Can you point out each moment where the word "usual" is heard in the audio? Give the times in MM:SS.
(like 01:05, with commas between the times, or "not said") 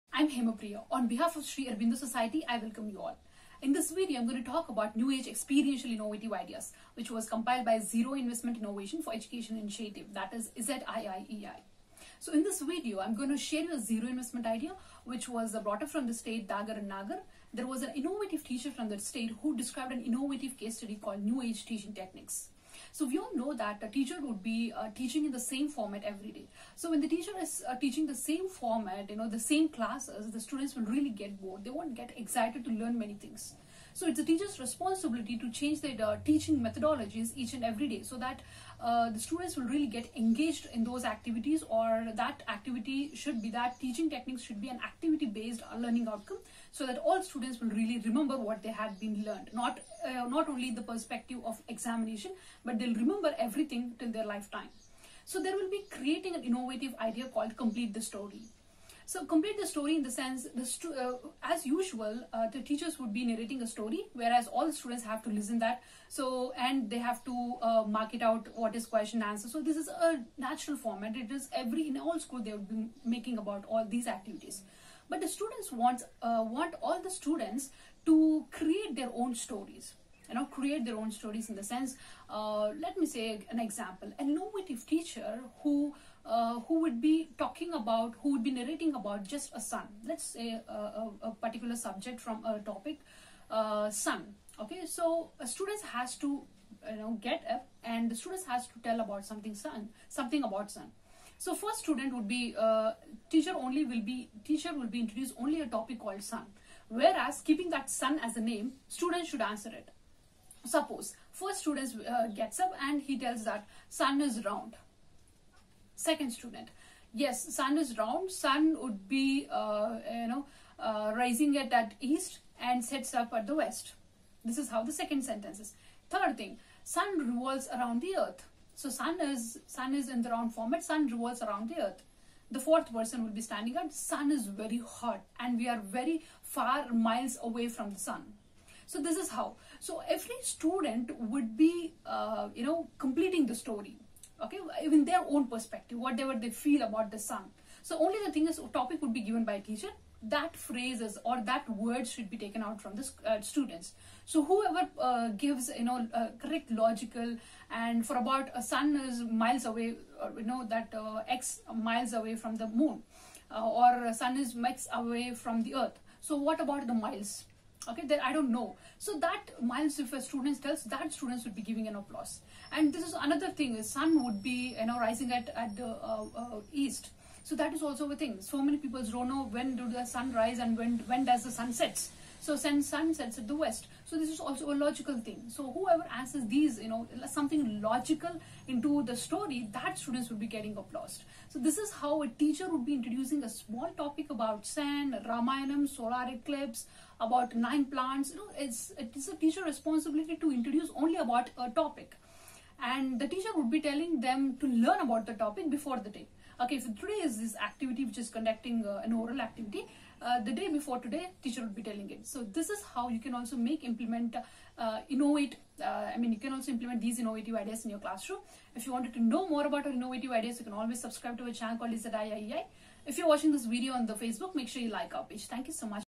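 01:01.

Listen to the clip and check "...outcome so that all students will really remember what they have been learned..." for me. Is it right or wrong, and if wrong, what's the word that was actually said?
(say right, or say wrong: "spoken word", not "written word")
right.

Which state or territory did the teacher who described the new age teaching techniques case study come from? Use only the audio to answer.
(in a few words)
Dadra and Nagar.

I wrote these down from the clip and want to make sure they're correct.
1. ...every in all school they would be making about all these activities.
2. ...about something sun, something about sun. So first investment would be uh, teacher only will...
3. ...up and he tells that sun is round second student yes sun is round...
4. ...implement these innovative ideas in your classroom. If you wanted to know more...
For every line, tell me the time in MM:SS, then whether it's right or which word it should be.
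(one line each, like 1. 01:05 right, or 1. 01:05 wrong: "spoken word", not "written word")
1. 01:11 right
2. 01:39 wrong: "student", not "investment"
3. 01:52 right
4. 03:36 right.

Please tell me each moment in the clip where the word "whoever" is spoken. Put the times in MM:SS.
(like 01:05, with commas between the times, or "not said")
02:34, 03:05.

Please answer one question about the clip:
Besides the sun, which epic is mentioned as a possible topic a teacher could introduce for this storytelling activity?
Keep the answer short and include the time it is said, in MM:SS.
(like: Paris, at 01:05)
Ramayanam, at 03:15.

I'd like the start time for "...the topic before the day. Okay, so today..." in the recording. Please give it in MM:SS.
03:25.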